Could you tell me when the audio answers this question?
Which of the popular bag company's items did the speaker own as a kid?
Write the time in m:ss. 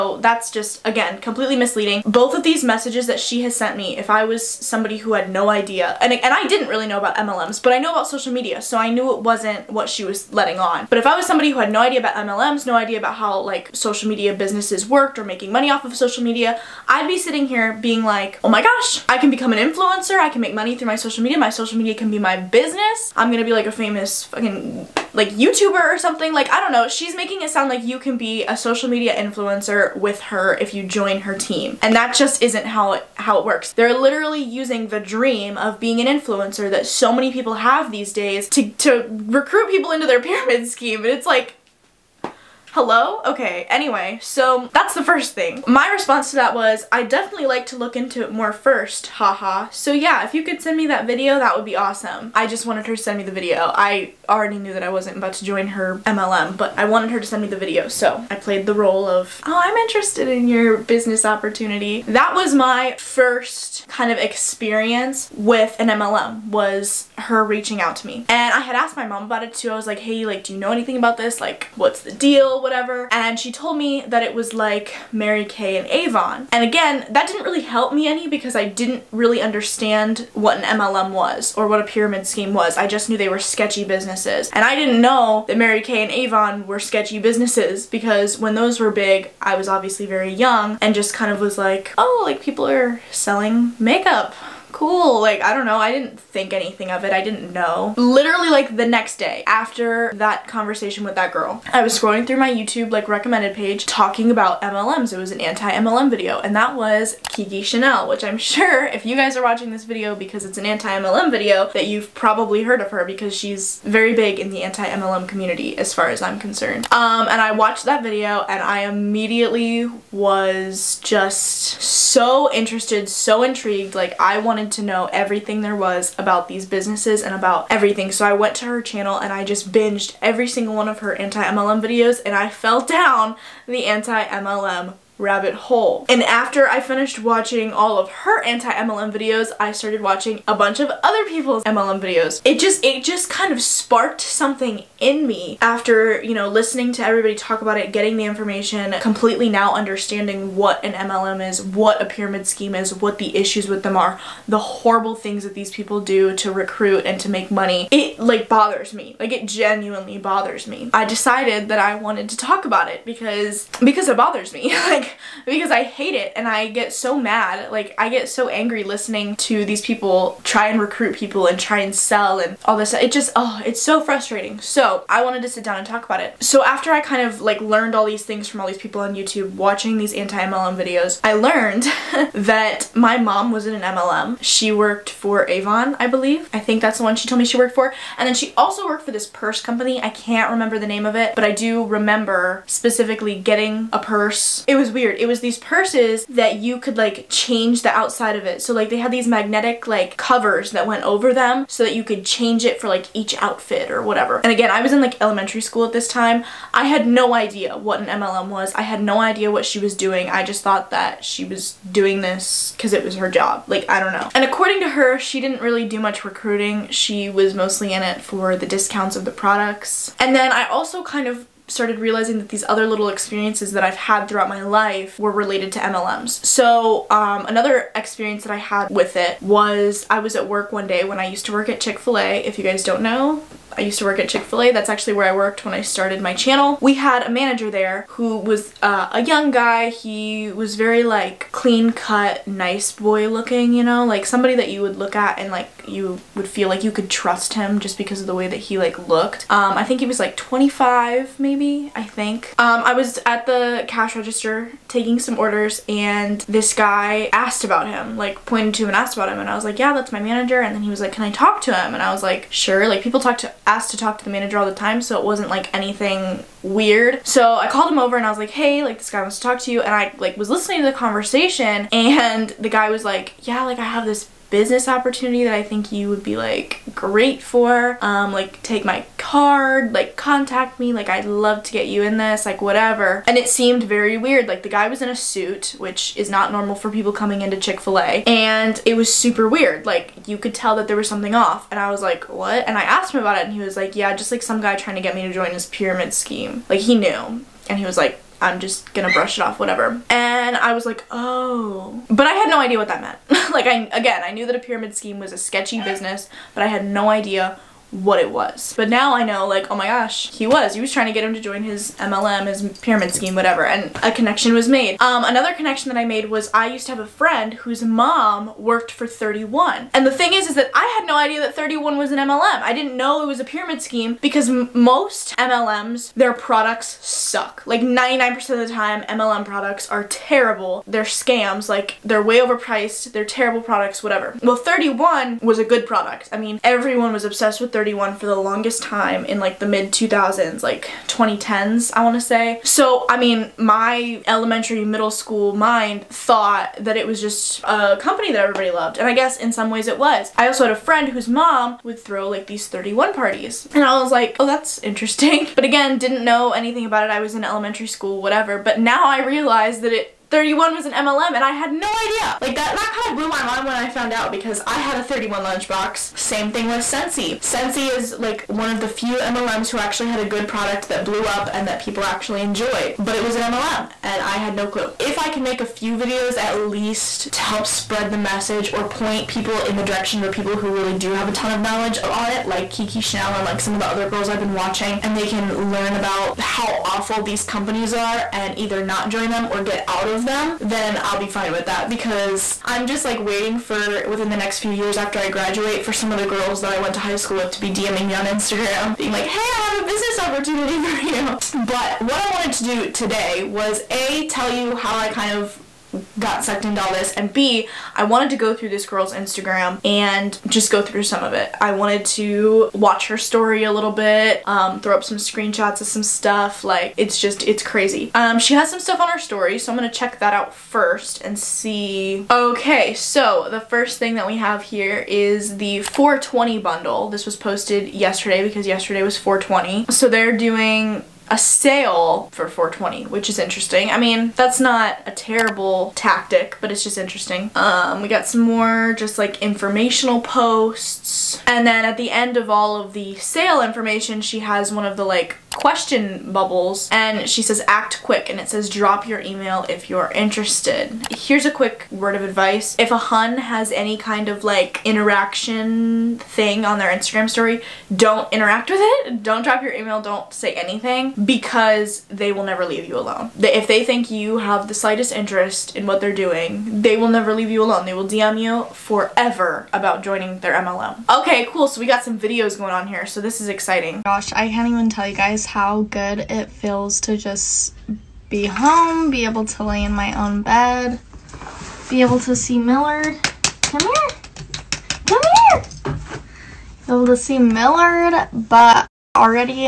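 6:05.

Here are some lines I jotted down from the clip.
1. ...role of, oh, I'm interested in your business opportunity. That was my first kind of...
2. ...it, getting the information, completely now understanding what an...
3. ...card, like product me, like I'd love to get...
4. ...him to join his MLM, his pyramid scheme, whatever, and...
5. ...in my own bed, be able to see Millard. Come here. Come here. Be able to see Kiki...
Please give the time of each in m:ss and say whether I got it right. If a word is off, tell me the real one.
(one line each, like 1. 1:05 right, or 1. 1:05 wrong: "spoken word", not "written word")
1. 0:58 right
2. 2:27 right
3. 4:39 wrong: "contact", not "product"
4. 5:11 right
5. 7:59 wrong: "Millard", not "Kiki".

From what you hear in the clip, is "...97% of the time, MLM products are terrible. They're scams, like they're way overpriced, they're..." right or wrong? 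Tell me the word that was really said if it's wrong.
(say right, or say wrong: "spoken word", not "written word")
wrong: "99", not "97".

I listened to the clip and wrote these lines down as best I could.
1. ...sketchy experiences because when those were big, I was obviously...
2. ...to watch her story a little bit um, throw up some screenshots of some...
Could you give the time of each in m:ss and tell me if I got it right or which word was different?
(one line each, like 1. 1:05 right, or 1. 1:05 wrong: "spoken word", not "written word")
1. 1:26 wrong: "businesses", not "experiences"
2. 6:52 right.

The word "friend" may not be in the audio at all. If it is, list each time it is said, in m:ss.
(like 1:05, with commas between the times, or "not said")
5:17, 5:50.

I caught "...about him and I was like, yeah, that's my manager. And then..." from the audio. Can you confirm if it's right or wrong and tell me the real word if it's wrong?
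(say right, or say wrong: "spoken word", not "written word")
right.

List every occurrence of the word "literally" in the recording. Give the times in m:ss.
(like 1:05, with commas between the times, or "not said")
0:33, 1:37.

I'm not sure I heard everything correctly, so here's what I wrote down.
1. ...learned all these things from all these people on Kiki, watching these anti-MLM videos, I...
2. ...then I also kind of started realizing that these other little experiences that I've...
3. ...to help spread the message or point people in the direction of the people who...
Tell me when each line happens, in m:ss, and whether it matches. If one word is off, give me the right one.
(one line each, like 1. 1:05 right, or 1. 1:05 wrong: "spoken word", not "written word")
1. 2:57 wrong: "YouTube", not "Kiki"
2. 3:40 right
3. 6:17 right.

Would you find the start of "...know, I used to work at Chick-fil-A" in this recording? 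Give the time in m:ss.
3:53.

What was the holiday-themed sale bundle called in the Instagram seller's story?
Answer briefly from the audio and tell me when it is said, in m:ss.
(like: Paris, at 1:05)
420 bundle, at 7:05.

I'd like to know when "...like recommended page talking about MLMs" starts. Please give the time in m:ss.
1:42.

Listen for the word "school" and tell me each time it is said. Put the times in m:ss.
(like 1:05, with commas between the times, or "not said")
3:25, 5:45, 5:57, 6:37.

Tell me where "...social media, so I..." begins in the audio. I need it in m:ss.
0:08.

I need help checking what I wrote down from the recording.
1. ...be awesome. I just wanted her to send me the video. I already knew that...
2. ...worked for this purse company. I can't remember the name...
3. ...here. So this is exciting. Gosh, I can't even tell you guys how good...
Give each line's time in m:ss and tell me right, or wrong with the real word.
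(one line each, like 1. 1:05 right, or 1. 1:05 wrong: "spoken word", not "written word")
1. 0:51 right
2. 3:08 right
3. 7:52 right.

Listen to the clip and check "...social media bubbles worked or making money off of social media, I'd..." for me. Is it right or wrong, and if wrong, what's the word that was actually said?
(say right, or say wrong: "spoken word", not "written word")
wrong: "businesses", not "bubbles".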